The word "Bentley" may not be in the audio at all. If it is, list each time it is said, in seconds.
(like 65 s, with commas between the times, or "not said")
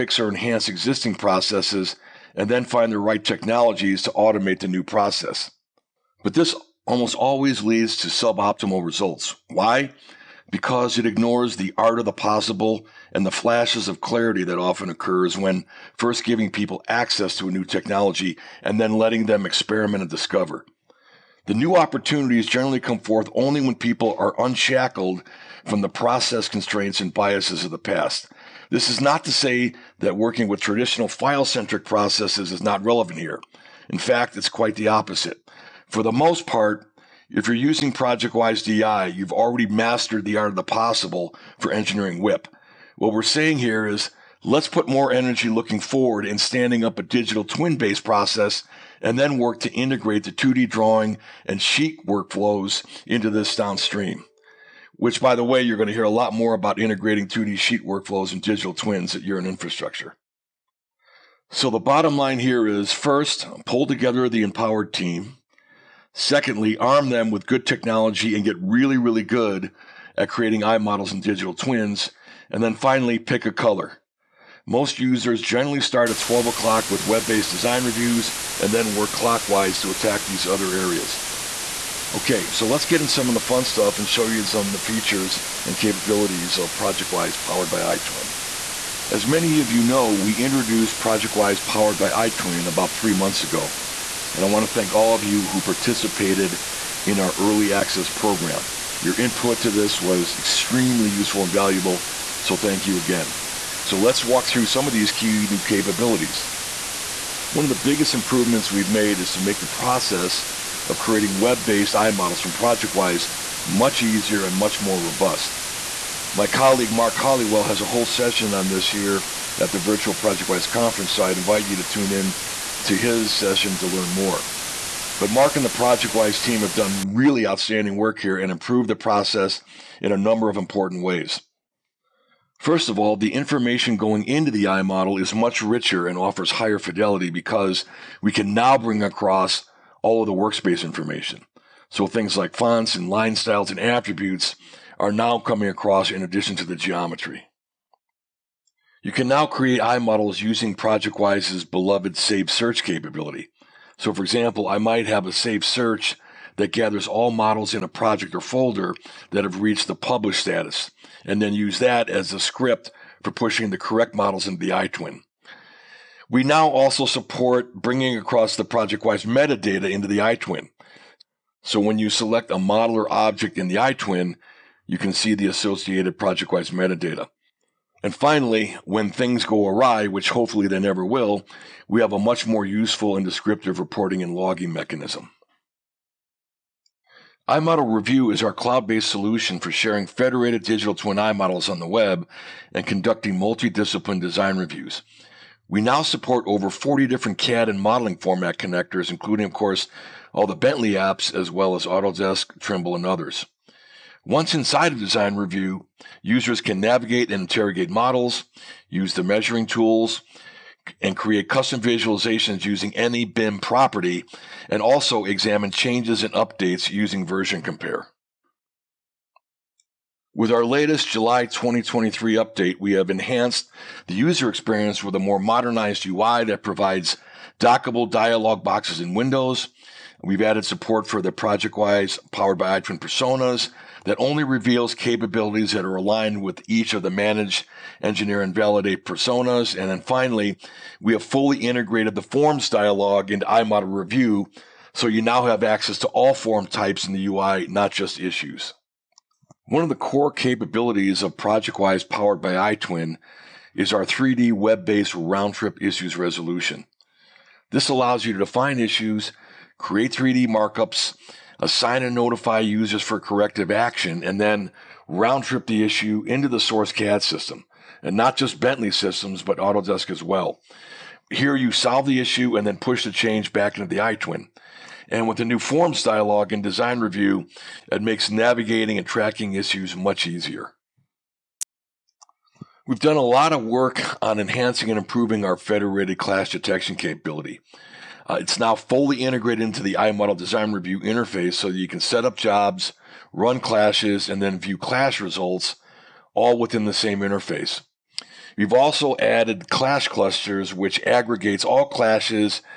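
200 s, 268 s.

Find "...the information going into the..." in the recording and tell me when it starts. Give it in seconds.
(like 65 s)
133 s.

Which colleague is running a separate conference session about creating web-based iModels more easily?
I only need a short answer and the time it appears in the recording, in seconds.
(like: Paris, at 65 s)
Mark Hollywell, at 116 s.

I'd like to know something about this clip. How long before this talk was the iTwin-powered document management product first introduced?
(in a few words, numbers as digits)
3 months.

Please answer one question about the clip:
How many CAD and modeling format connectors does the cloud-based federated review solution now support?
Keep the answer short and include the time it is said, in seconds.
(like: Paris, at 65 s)
over 40, at 196 s.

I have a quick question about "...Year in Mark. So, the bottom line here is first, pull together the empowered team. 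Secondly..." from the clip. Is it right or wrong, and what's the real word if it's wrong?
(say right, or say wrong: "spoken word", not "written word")
wrong: "Infrastructure", not "Mark".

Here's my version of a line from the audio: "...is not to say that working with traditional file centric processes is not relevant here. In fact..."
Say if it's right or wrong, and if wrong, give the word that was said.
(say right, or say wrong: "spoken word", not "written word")
right.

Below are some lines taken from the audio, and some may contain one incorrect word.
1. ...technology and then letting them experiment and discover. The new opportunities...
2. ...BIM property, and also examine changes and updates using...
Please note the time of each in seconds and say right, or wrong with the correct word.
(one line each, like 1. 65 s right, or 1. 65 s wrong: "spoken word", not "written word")
1. 17 s right
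2. 213 s right.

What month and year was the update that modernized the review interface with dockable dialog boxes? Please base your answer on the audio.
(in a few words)
July 2023.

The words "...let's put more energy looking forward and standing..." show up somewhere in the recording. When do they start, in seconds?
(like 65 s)
44 s.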